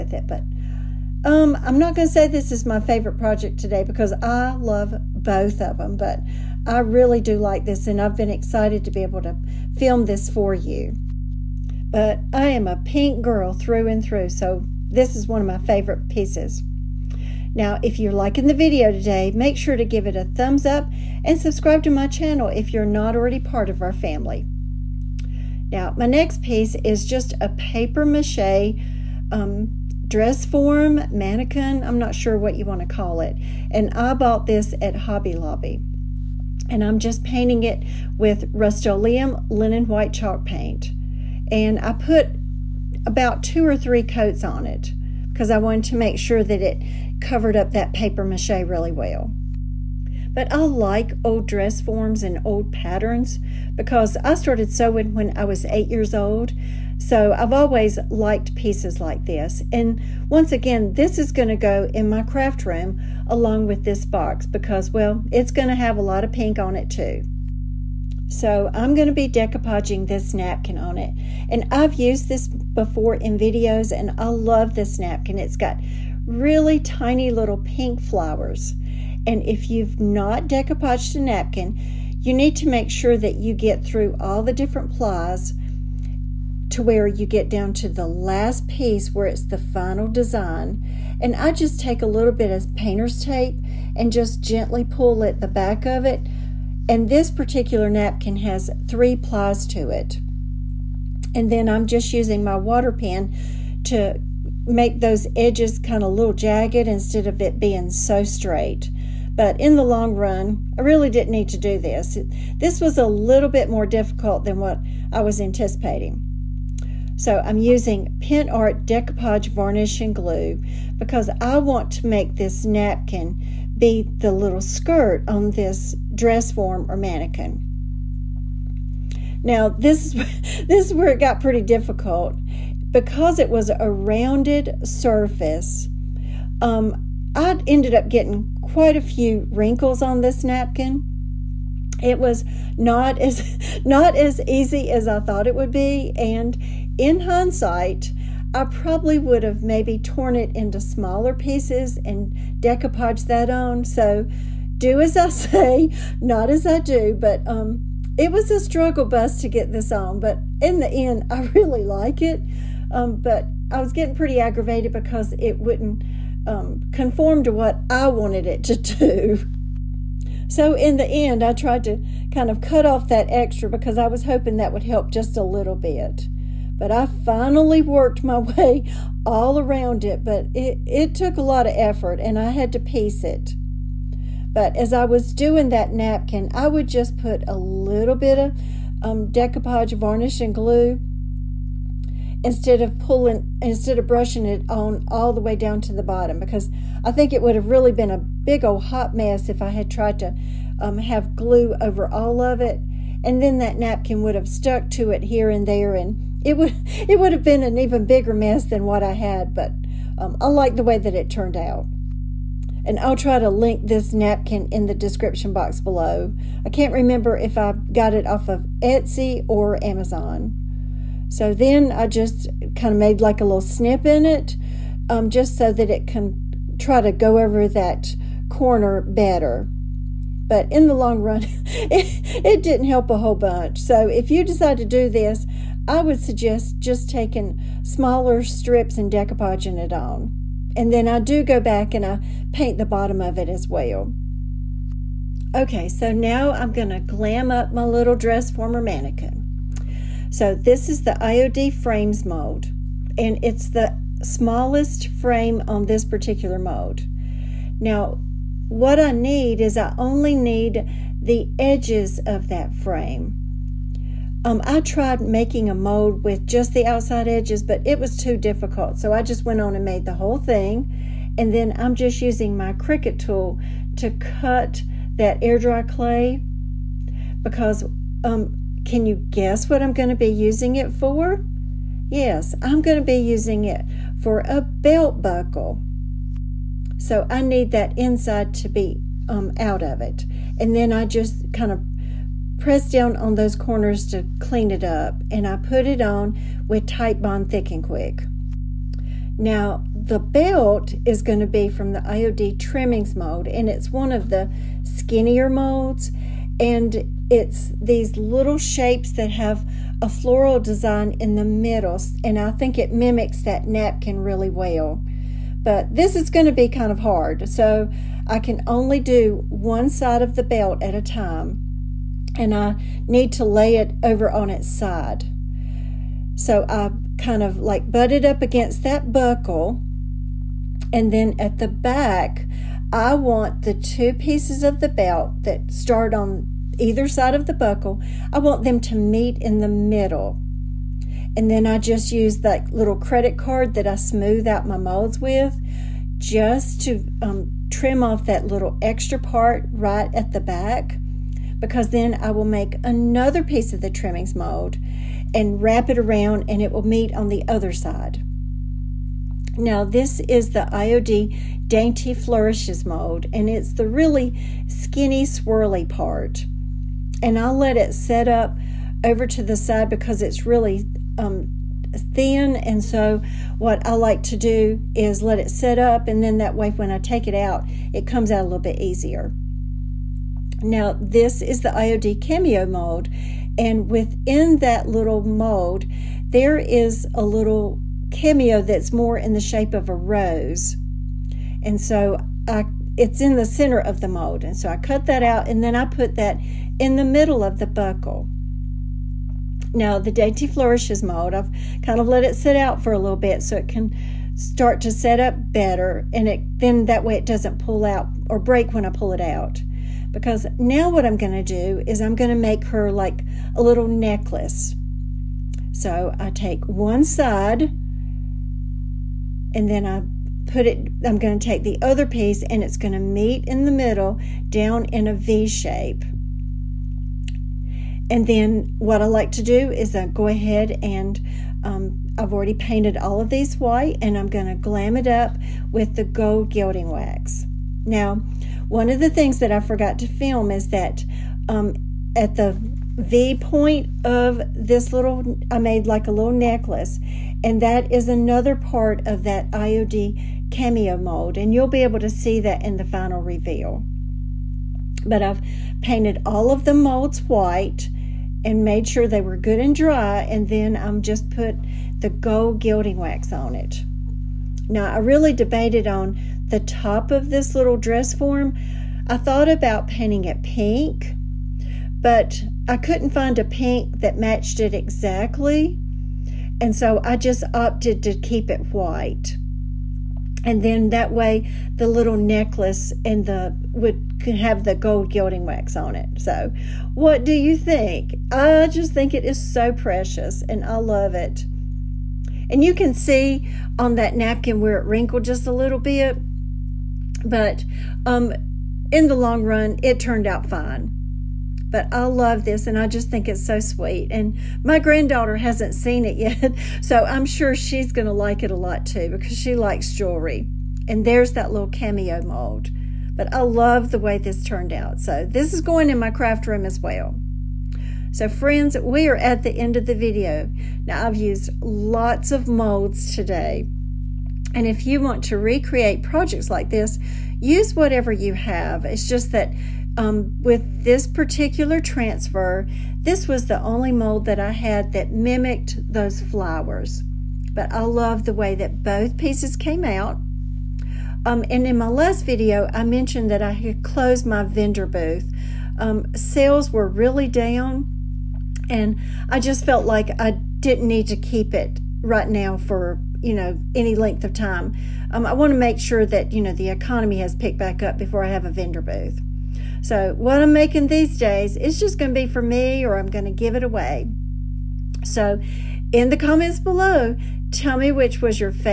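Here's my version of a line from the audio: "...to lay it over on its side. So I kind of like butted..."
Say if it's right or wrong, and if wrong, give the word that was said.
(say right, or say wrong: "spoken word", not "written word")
right.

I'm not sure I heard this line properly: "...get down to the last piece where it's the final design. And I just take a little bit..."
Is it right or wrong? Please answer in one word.
right.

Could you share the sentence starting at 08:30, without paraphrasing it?
And there's that little cameo mold.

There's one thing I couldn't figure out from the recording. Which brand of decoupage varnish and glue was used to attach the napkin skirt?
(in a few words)
Pentart.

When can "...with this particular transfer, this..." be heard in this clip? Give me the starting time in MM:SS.
08:50.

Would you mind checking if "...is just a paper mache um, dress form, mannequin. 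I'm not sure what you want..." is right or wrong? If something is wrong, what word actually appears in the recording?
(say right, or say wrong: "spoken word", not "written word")
right.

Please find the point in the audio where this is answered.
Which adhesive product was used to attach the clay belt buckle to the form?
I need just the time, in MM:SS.
04:56.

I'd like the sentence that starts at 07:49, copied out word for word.
I thought about painting it pink, but I couldn't find a pink that matched it exactly.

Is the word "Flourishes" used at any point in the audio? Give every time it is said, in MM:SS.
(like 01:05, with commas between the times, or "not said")
06:02, 06:40.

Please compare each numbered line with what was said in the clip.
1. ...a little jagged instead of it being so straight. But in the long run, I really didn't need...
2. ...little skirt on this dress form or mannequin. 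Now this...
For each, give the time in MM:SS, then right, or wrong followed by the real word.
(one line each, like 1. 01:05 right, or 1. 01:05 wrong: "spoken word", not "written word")
1. 01:46 right
2. 02:04 right.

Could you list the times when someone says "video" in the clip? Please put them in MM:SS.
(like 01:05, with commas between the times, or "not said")
00:18, 01:13, 08:39, 09:02.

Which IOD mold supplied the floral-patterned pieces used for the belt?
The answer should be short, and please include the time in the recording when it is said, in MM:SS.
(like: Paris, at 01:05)
IOD trimmings mold, at 05:02.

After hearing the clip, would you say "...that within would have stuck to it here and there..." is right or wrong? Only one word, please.
wrong.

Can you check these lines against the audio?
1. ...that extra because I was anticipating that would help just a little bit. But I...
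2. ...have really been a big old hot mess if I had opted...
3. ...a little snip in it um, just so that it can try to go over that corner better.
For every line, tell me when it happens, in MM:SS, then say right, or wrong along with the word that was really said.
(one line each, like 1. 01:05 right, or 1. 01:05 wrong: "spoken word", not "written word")
1. 02:53 wrong: "hoping", not "anticipating"
2. 03:17 wrong: "tried", not "opted"
3. 03:43 right.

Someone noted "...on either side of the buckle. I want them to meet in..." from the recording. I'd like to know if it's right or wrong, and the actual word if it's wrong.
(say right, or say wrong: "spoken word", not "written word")
right.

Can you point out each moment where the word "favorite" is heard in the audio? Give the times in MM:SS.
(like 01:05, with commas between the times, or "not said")
00:02, 00:15.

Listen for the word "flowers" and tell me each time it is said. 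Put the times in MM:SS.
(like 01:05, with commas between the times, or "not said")
01:17, 08:56.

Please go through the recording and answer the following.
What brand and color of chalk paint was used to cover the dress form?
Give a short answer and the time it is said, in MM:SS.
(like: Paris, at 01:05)
Rust-Oleum linen white, at 00:38.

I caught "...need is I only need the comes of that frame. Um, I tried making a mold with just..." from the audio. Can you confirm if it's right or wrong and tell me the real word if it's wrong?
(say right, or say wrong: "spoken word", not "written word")
wrong: "edges", not "comes".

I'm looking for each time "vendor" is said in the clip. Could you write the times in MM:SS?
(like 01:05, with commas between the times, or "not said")
09:04, 09:18.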